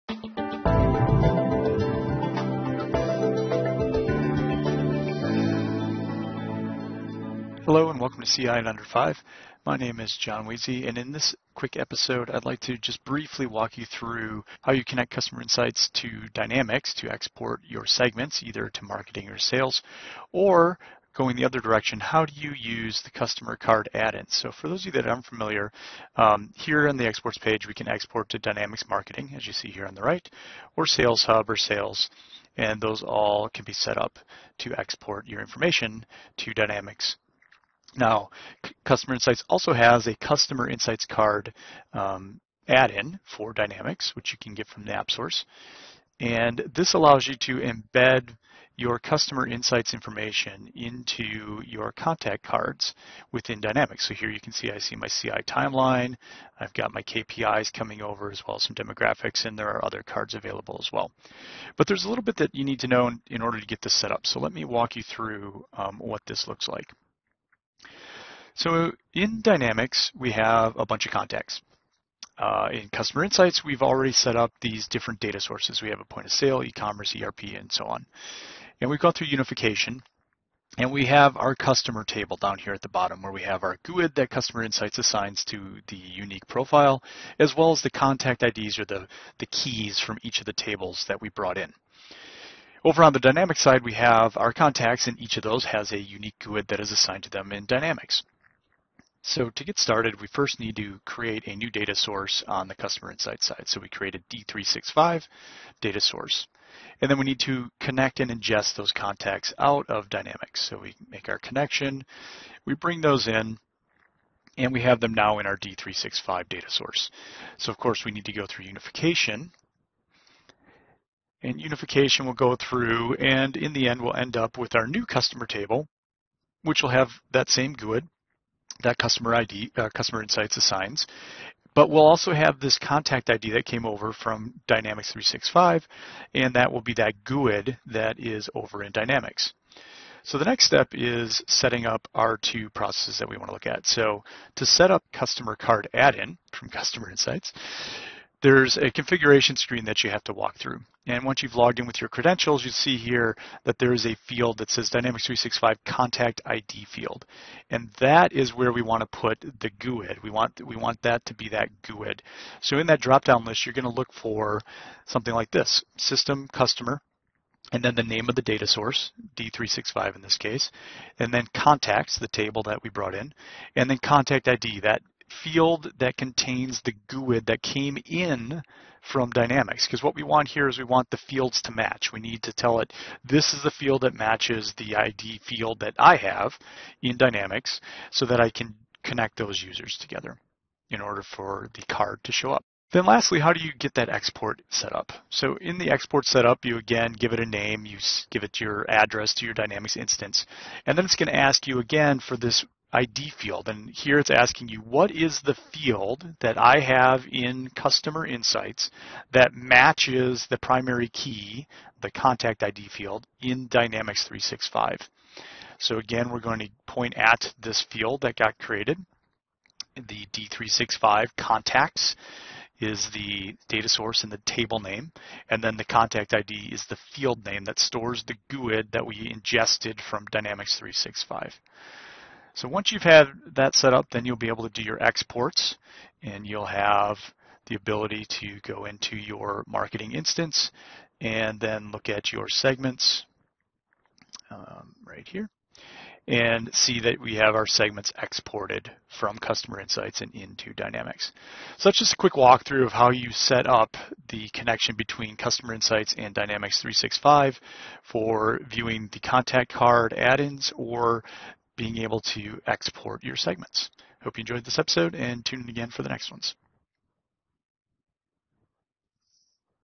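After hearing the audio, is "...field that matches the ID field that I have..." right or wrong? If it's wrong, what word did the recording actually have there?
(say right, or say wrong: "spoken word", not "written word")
right.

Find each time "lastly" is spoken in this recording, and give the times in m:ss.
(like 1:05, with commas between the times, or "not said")
3:13.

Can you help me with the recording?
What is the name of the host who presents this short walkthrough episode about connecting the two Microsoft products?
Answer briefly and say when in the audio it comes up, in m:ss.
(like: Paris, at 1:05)
John Weezy, at 0:10.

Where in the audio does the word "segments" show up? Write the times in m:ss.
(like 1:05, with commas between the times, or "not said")
0:17, 4:02, 4:07, 4:23.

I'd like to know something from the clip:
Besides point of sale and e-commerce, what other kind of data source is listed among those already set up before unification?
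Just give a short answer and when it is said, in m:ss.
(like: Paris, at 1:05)
ERP, at 1:17.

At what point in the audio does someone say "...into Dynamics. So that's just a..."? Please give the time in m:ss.
4:10.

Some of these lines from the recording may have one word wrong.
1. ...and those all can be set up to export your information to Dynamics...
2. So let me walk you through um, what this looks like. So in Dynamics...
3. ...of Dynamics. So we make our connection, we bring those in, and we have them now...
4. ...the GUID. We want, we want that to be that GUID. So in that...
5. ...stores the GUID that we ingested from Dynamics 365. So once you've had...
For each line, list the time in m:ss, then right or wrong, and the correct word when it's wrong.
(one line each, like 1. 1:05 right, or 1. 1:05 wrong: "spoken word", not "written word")
1. 0:32 right
2. 1:04 right
3. 1:49 right
4. 2:39 right
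5. 3:47 right.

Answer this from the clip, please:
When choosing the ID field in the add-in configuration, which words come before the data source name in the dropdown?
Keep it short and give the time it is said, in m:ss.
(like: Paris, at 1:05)
System Customer, at 2:45.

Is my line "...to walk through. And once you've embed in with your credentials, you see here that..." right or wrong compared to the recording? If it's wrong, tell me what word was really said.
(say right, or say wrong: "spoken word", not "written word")
wrong: "logged", not "embed".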